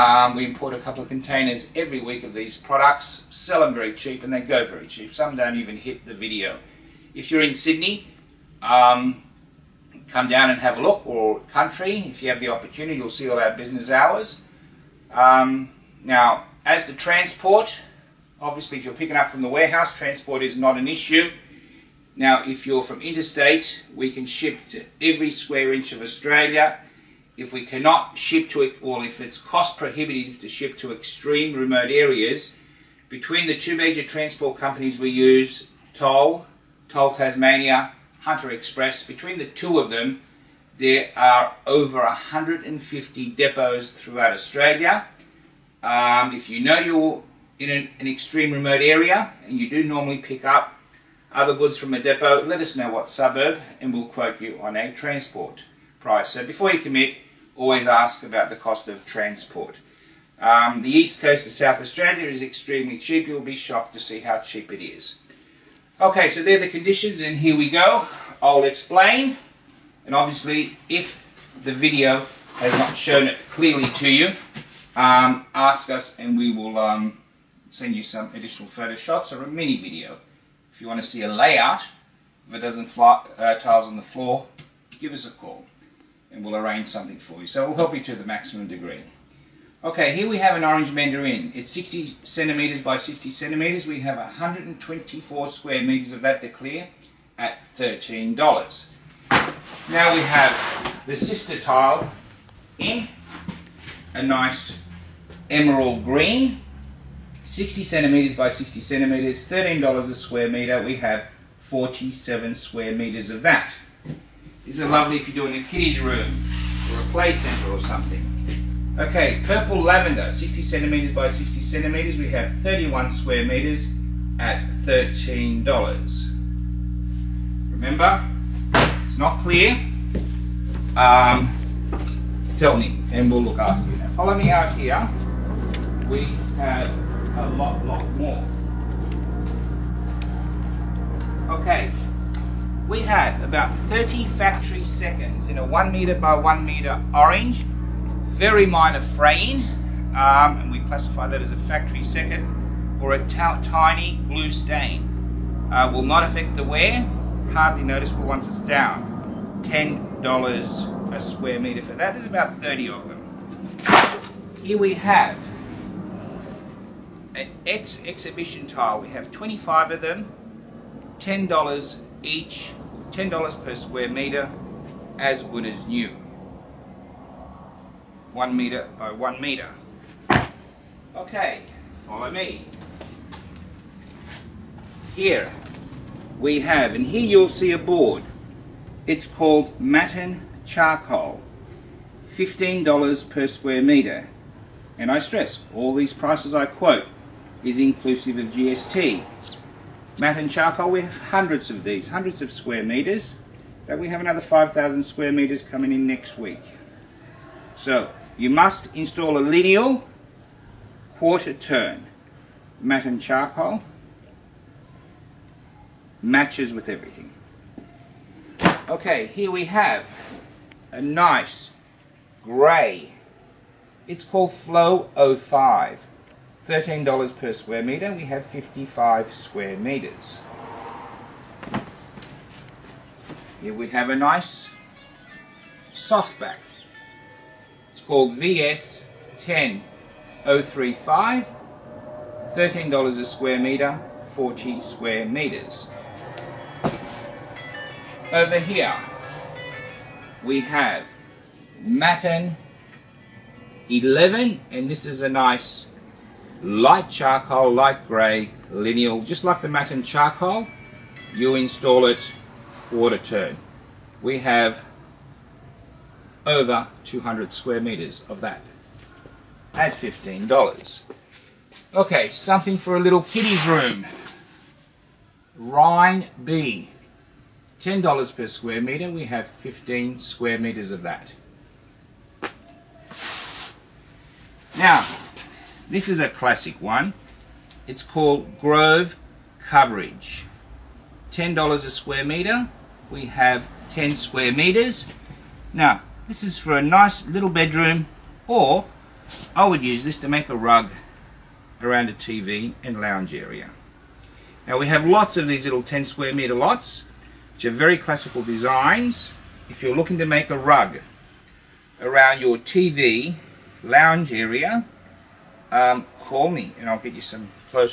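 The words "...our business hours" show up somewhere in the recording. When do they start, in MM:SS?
00:13.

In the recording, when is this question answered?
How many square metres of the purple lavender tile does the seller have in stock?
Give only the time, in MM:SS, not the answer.
02:02.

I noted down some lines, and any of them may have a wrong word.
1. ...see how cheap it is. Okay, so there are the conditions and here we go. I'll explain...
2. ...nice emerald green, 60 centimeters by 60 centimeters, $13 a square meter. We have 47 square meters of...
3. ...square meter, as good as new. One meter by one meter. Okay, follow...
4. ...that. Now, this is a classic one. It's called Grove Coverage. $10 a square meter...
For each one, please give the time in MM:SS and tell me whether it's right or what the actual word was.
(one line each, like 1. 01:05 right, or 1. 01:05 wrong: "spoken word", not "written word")
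1. 01:03 right
2. 01:44 right
3. 02:53 right
4. 04:41 right.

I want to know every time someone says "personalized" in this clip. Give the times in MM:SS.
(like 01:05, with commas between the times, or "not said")
not said.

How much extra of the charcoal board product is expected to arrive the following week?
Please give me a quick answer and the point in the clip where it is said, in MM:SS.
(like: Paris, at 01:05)
5,000 square metres, at 03:24.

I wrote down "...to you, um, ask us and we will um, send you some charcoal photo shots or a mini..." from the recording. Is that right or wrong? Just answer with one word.
wrong.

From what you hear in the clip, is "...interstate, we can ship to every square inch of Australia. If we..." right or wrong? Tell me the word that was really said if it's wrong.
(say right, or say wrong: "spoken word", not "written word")
right.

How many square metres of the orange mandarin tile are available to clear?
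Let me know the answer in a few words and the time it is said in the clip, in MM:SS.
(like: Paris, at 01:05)
124, at 01:34.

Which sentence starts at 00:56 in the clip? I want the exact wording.
So before you commit, always ask about the cost of transport.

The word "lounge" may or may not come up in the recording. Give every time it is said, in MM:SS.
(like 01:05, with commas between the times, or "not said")
05:02, 05:13.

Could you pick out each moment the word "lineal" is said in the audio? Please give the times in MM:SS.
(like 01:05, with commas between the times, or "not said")
03:29, 04:18.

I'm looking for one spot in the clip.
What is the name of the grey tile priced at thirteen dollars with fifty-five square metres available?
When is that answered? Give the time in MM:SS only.
03:44.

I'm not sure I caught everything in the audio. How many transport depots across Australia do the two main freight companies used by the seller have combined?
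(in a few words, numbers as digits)
over 150.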